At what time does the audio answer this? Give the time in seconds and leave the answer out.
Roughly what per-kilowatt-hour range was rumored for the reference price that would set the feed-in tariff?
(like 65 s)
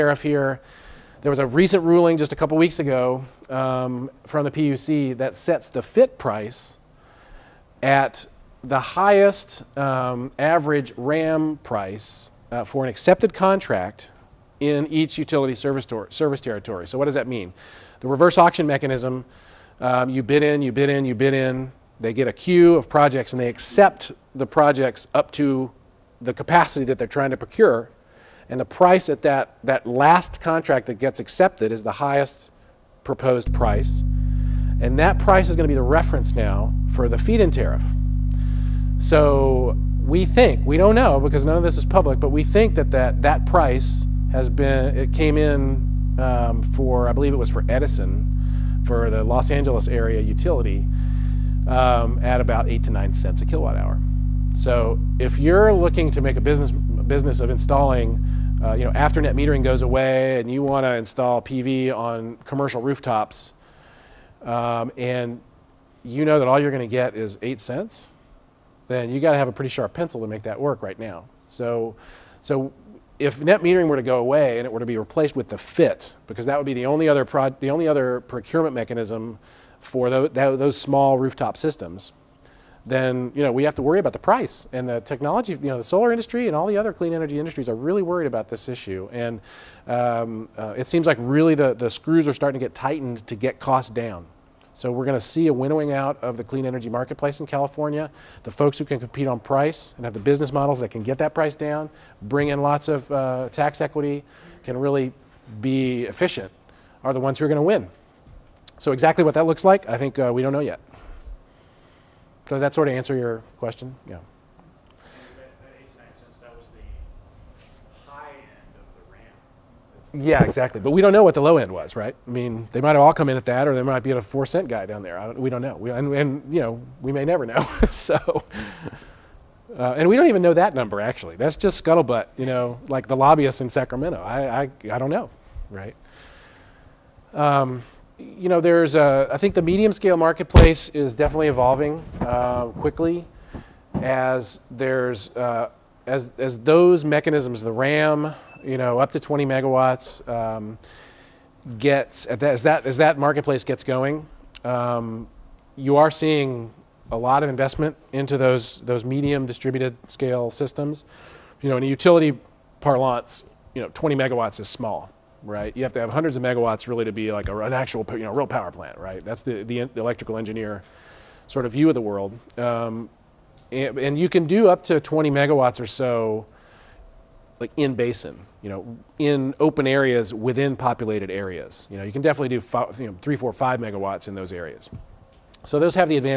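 52 s.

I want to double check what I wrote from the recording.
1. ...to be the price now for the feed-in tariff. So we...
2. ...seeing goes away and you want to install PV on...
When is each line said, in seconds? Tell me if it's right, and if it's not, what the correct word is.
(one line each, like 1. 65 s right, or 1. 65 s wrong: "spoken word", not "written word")
1. 35 s wrong: "reference", not "price"
2. 59 s wrong: "metering", not "seeing".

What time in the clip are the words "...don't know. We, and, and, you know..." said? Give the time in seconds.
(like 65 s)
125 s.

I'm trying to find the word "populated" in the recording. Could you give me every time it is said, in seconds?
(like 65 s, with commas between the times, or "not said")
180 s.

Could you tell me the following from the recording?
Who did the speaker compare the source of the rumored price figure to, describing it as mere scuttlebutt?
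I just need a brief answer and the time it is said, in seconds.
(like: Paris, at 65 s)
Lobbyists in Sacramento, at 133 s.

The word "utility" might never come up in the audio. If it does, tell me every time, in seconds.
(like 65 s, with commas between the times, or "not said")
15 s, 50 s, 161 s.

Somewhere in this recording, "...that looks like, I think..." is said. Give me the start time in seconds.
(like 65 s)
109 s.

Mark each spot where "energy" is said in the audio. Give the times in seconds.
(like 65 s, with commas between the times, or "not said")
87 s, 96 s.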